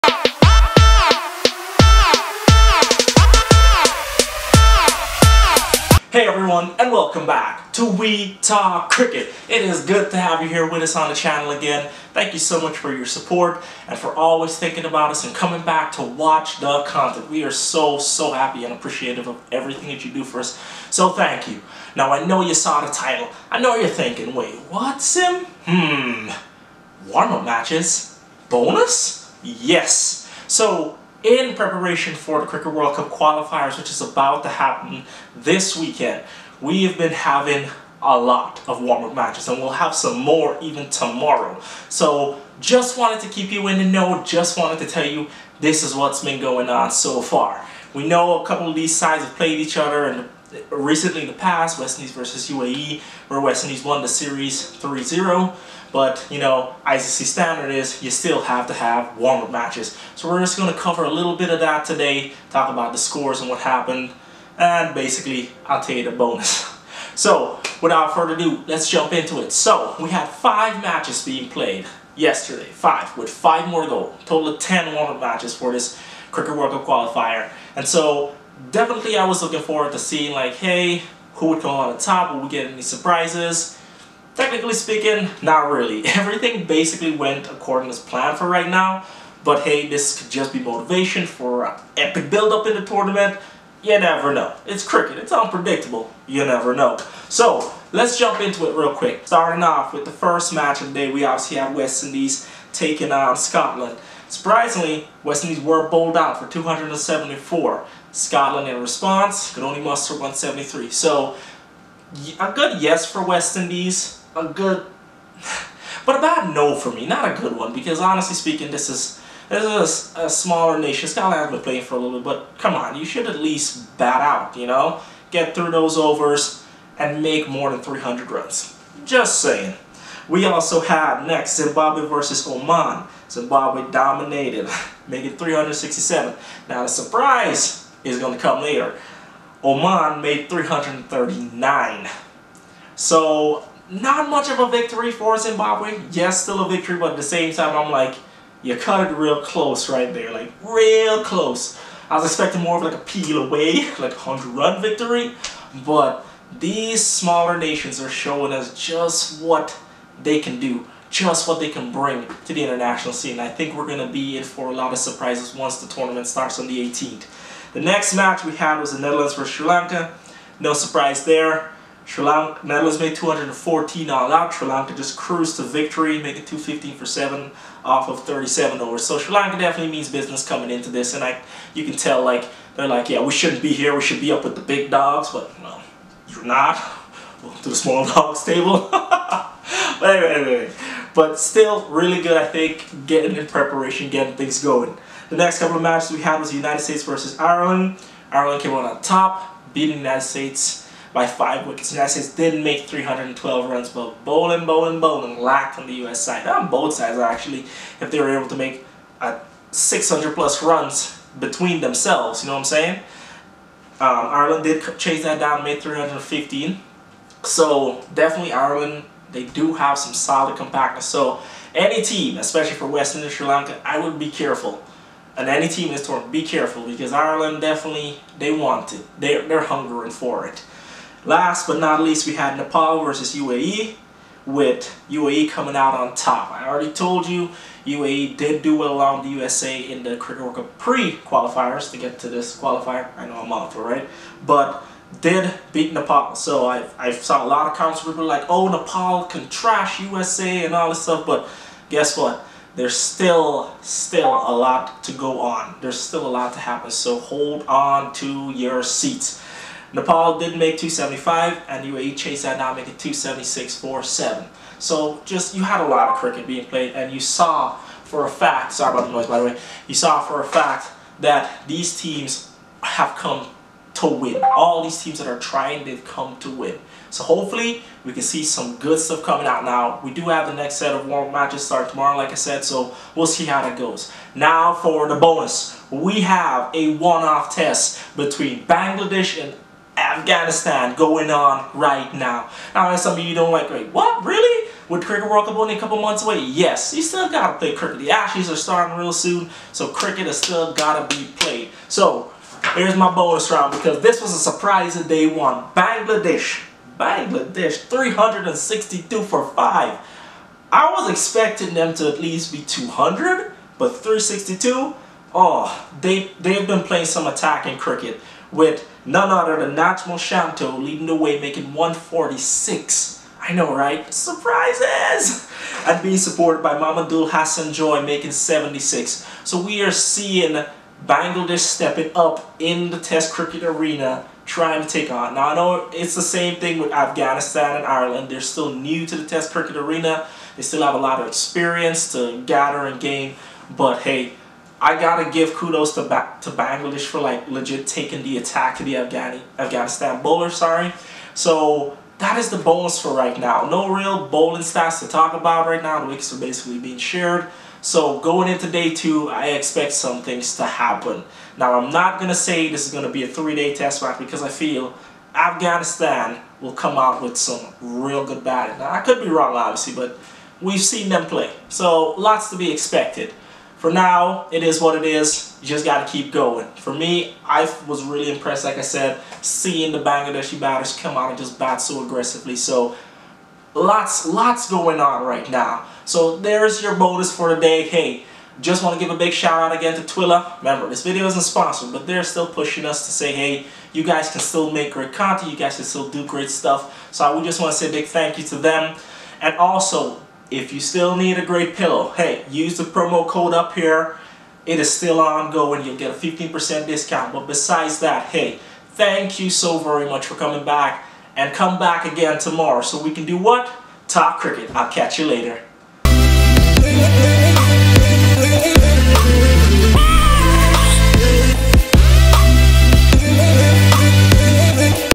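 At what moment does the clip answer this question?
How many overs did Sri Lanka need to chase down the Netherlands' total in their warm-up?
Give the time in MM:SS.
02:58.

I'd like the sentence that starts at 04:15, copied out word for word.
There's still a lot to happen.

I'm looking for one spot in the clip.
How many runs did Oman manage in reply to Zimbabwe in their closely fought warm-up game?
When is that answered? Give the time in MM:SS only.
02:20.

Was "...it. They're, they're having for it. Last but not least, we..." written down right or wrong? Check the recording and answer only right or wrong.
wrong.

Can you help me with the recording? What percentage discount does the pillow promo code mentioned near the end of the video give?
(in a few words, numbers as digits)
15%.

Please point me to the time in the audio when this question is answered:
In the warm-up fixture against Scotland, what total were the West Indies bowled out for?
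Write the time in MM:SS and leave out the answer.
01:46.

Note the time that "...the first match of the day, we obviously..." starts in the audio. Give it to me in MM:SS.
01:40.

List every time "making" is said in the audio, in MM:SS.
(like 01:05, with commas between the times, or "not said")
02:15, 02:56, 04:22, 05:21, 05:28.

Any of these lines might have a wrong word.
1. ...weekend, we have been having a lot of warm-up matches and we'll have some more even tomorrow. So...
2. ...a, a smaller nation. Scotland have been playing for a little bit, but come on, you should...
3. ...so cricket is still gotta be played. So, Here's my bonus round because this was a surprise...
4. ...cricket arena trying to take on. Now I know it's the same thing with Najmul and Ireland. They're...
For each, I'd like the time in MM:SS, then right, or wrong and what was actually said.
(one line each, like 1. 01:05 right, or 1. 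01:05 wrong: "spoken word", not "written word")
1. 00:35 right
2. 02:00 right
3. 04:59 right
4. 05:33 wrong: "Afghanistan", not "Najmul".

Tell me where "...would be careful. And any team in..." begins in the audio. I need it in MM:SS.
03:43.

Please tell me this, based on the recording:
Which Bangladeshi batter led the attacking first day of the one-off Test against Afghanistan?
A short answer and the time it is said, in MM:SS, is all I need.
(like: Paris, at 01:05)
Najmul Shanto, at 05:19.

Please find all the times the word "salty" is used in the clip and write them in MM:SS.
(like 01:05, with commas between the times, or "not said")
not said.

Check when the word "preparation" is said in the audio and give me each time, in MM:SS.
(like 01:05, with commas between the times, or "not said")
00:31, 03:13.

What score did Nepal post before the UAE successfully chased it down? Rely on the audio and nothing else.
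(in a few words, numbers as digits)
275.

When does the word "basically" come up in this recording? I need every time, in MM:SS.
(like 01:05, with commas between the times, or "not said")
01:04, 01:26, 05:56.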